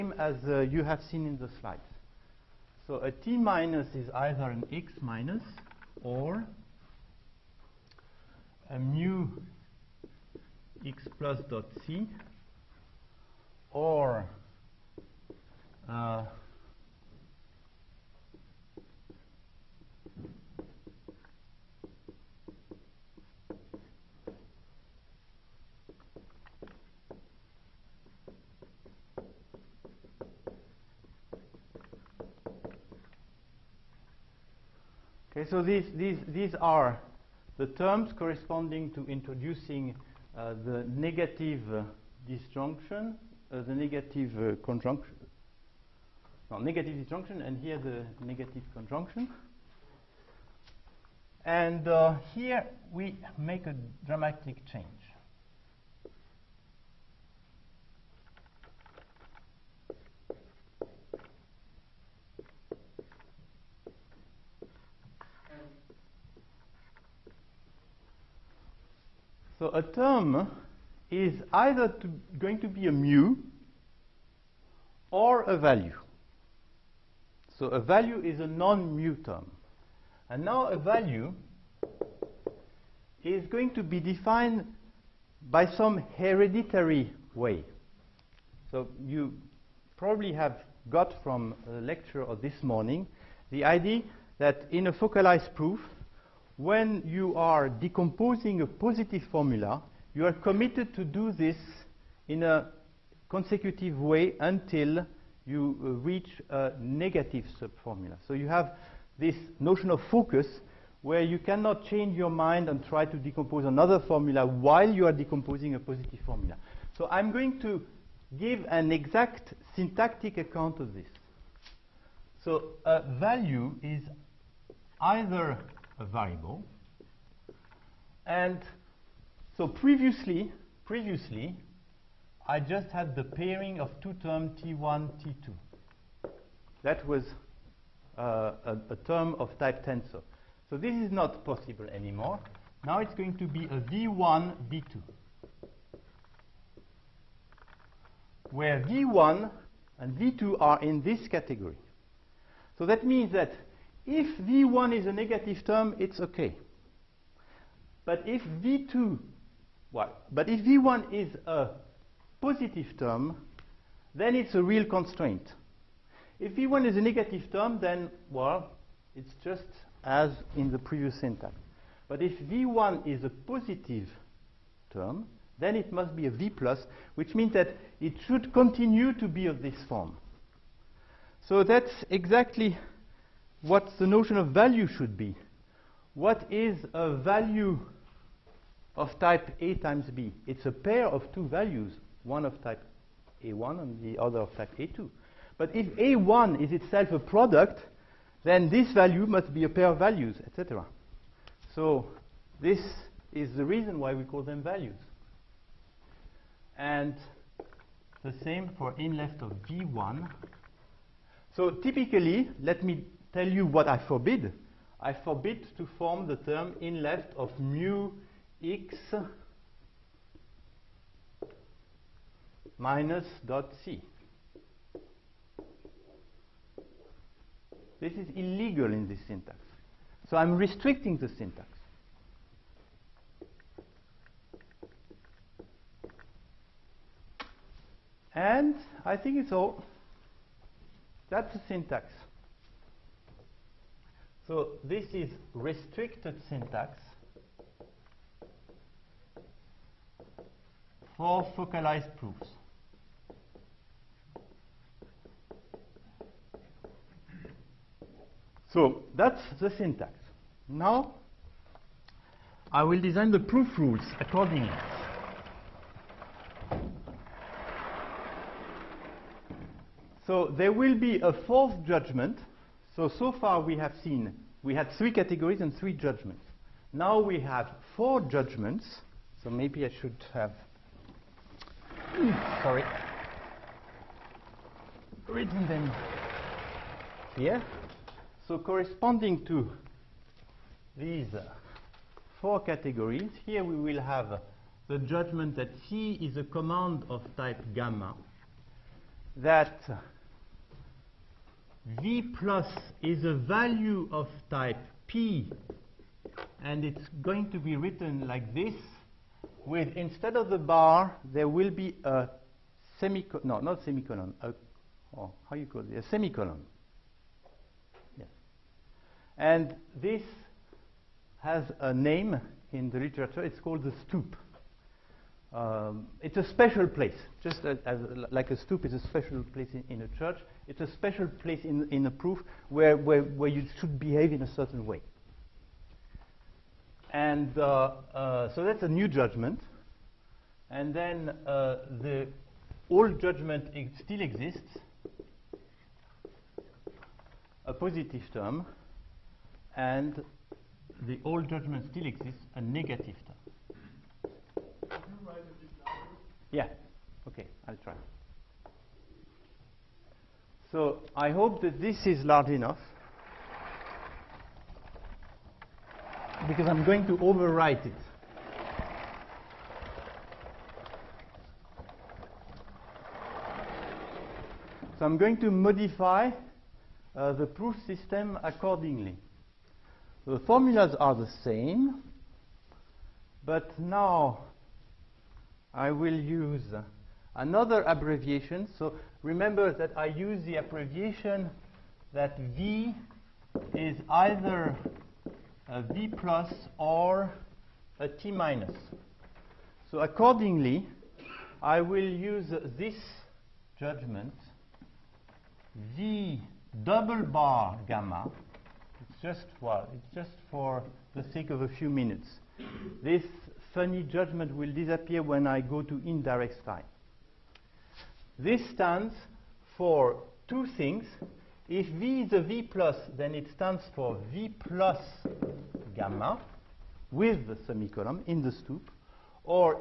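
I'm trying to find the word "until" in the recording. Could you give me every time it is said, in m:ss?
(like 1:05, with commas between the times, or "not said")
1:44.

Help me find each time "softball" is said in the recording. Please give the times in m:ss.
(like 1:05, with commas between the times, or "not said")
not said.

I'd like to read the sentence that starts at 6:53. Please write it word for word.
This funny judgment will disappear when I go to indirect time.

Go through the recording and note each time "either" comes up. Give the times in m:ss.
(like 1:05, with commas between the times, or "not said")
0:04, 1:11, 2:05, 6:34.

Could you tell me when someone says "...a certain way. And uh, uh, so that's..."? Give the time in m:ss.
5:34.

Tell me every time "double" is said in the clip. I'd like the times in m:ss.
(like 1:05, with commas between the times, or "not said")
6:46.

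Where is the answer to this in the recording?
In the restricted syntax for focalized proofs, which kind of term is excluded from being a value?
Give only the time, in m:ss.
1:18.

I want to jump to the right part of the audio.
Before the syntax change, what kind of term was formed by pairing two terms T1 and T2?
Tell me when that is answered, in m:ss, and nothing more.
2:19.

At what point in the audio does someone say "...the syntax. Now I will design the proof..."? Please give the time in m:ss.
4:19.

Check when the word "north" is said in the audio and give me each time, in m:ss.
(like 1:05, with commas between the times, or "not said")
not said.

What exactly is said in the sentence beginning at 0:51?
And uh, here we make a dramatic change.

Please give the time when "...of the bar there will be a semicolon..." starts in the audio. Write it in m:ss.
5:10.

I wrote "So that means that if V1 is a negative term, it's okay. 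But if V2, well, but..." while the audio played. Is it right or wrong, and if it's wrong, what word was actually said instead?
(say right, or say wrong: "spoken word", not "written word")
right.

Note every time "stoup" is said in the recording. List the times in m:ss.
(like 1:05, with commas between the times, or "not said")
5:24, 5:28, 7:08.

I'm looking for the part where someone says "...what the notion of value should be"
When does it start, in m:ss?
3:03.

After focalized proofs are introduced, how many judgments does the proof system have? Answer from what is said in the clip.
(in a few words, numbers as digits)
4.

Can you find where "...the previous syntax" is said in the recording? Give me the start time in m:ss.
2:50.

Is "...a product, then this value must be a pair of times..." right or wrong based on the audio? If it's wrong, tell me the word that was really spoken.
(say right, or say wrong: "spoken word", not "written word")
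wrong: "values", not "times".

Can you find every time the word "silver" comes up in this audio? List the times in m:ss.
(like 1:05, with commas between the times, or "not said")
not said.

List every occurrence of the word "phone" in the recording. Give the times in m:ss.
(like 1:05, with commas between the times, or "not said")
not said.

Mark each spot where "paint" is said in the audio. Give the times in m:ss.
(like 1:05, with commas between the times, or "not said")
not said.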